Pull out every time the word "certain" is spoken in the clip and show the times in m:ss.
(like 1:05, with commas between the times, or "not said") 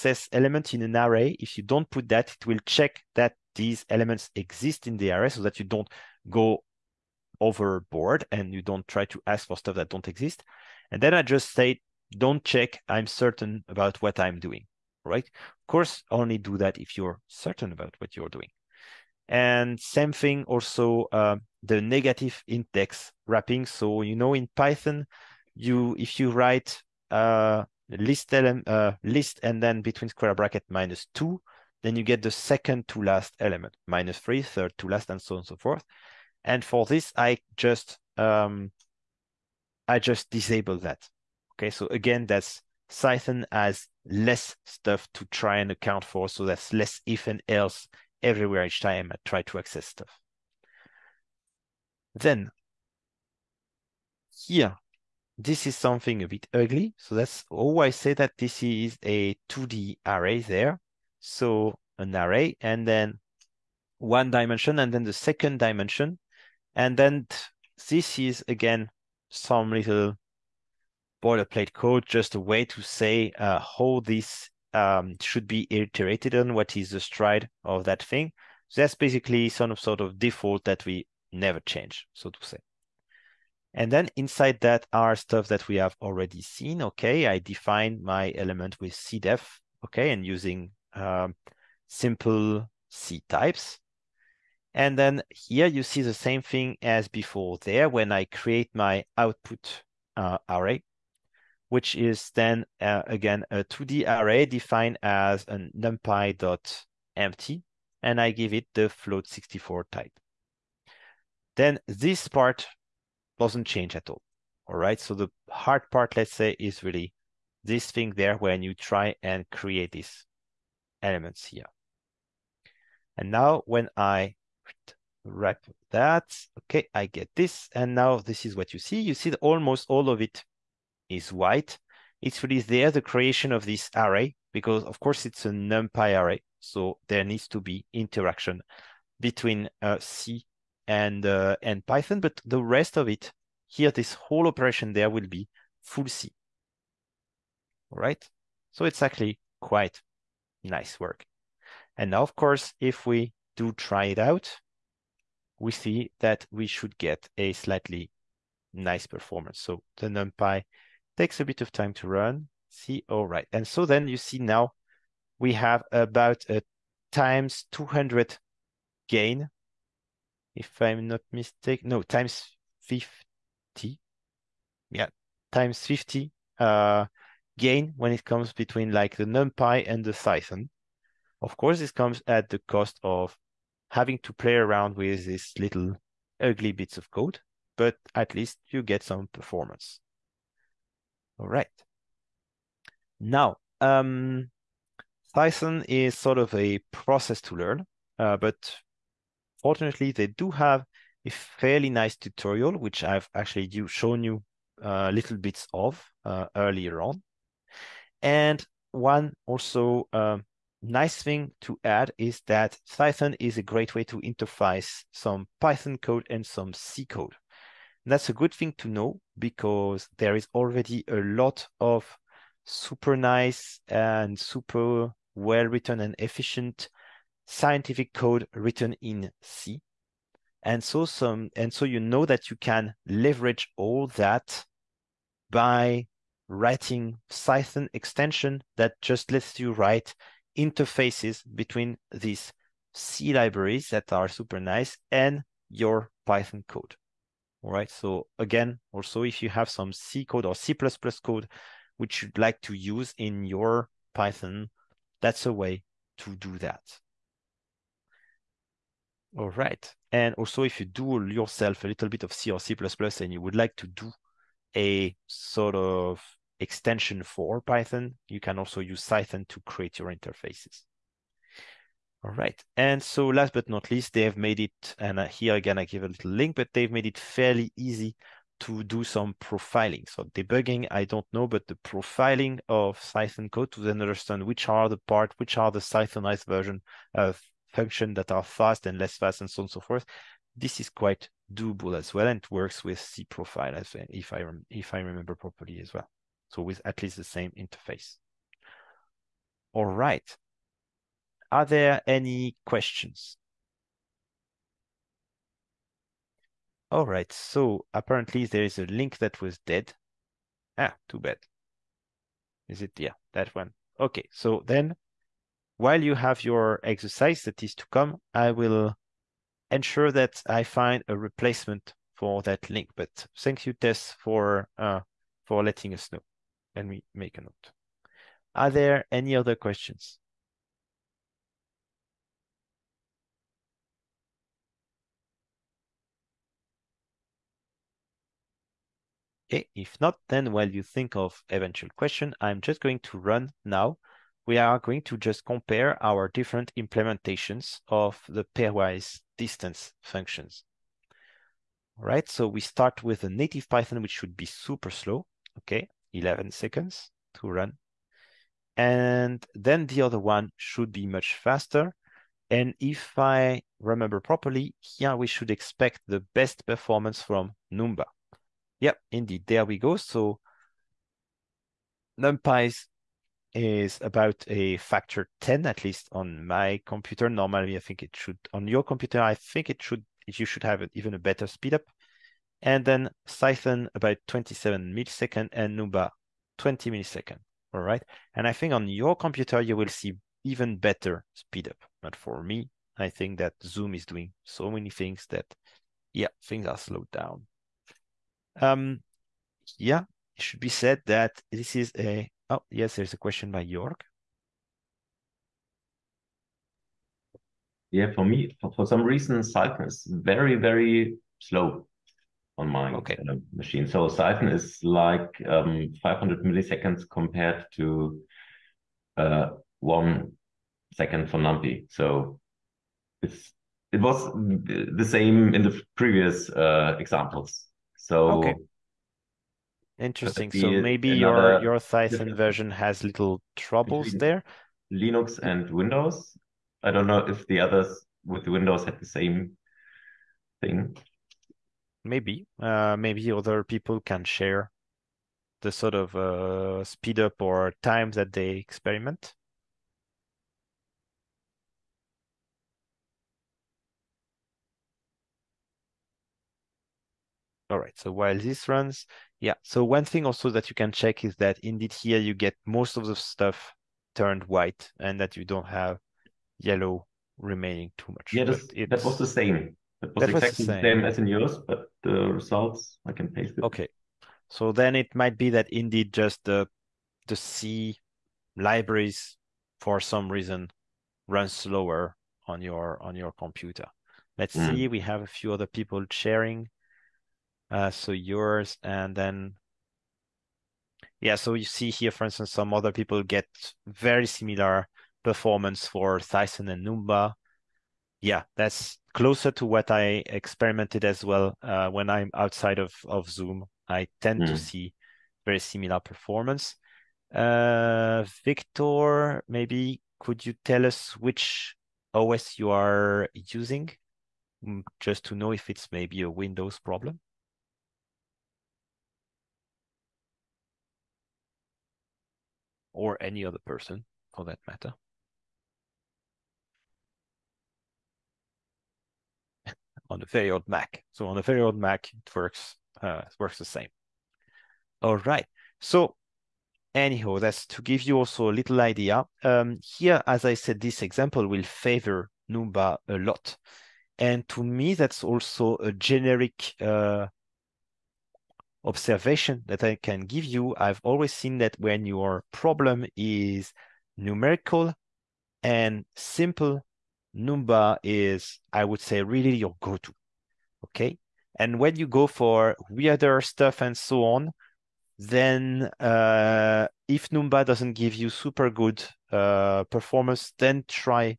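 0:13, 0:17.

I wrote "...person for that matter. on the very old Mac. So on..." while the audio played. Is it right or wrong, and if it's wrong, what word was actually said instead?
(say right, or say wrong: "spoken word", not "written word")
right.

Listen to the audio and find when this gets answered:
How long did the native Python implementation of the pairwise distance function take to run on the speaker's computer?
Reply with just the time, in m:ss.
5:56.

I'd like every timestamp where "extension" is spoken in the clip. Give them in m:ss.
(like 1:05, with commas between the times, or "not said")
3:57, 4:26.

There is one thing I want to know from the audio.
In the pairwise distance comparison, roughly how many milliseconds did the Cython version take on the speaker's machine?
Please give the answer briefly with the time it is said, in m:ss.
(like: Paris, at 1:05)
27 milliseconds, at 6:24.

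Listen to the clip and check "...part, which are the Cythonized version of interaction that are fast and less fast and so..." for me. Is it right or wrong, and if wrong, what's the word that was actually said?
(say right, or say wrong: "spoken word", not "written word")
wrong: "function", not "interaction".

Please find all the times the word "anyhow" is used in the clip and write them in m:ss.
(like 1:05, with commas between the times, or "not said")
8:56.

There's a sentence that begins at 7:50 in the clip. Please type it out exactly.
That was, that was exactly the same.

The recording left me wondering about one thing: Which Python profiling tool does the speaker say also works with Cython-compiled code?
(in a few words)
cProfile.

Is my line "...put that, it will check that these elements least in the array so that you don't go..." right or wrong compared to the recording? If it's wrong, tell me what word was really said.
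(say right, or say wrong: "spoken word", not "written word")
wrong: "exist", not "least".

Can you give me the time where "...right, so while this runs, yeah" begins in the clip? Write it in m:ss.
7:37.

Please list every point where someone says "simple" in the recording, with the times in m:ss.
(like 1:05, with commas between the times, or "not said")
1:31, 9:16.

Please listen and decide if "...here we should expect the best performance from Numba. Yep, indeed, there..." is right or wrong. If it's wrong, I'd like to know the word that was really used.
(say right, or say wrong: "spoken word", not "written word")
right.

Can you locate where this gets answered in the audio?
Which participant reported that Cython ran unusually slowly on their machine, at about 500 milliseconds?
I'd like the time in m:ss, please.
6:43.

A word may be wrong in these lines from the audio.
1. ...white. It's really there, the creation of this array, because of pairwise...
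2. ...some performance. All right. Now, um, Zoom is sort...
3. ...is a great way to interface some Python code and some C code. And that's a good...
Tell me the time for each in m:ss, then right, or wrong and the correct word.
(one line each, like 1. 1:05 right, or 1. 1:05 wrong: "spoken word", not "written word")
1. 2:11 wrong: "course", not "pairwise"
2. 3:09 wrong: "Cython", not "Zoom"
3. 3:33 right.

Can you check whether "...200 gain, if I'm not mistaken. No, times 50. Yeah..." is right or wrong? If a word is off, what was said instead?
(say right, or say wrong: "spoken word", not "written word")
right.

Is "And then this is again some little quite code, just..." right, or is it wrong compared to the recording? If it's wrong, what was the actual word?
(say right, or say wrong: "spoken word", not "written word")
wrong: "boilerplate", not "quite".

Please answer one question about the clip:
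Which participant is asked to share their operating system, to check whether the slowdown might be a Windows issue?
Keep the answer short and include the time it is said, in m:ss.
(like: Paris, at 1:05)
Victor, at 8:28.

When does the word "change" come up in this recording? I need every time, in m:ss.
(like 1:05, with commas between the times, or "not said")
1:21, 1:53.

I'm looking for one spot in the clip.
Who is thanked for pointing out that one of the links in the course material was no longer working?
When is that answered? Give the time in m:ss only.
5:23.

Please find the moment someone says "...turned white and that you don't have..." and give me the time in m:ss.
7:44.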